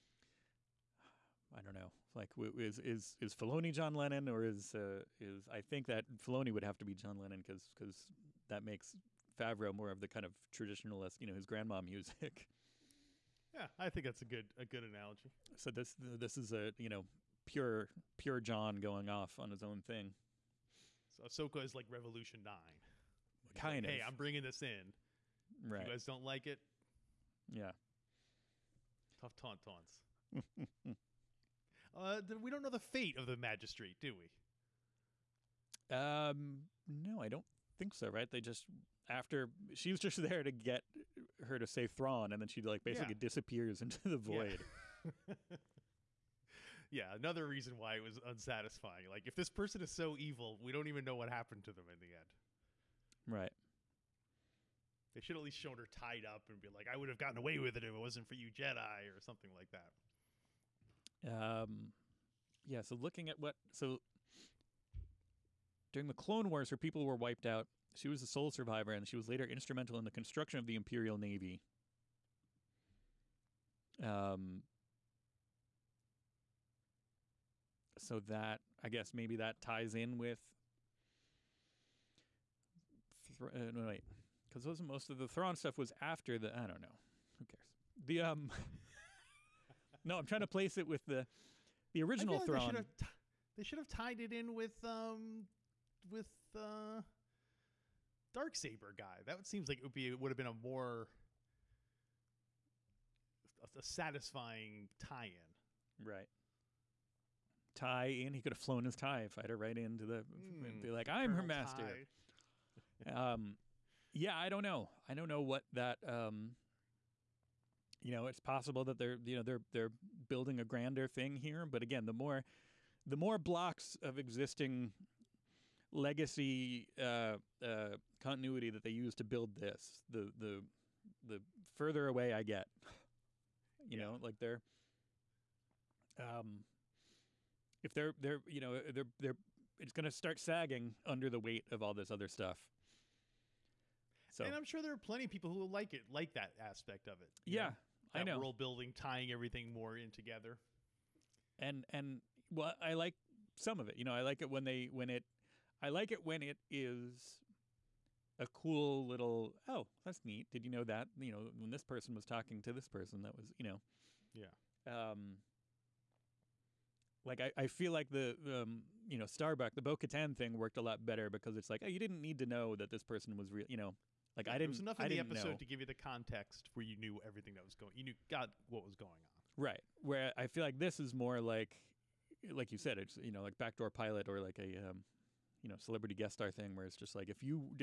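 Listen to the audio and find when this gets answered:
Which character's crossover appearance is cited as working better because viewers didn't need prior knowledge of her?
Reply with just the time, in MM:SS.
02:49.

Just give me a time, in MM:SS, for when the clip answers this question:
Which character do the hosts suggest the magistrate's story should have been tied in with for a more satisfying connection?
01:38.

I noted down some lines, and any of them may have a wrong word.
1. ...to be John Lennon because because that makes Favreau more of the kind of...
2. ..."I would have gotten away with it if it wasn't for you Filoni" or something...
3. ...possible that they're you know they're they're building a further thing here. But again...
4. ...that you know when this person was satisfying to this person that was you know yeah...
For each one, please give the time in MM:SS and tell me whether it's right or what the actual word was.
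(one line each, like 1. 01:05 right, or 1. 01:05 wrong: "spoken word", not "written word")
1. 00:06 right
2. 00:56 wrong: "Jedi", not "Filoni"
3. 01:58 wrong: "grander", not "further"
4. 02:40 wrong: "talking", not "satisfying".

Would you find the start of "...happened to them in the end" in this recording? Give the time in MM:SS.
00:51.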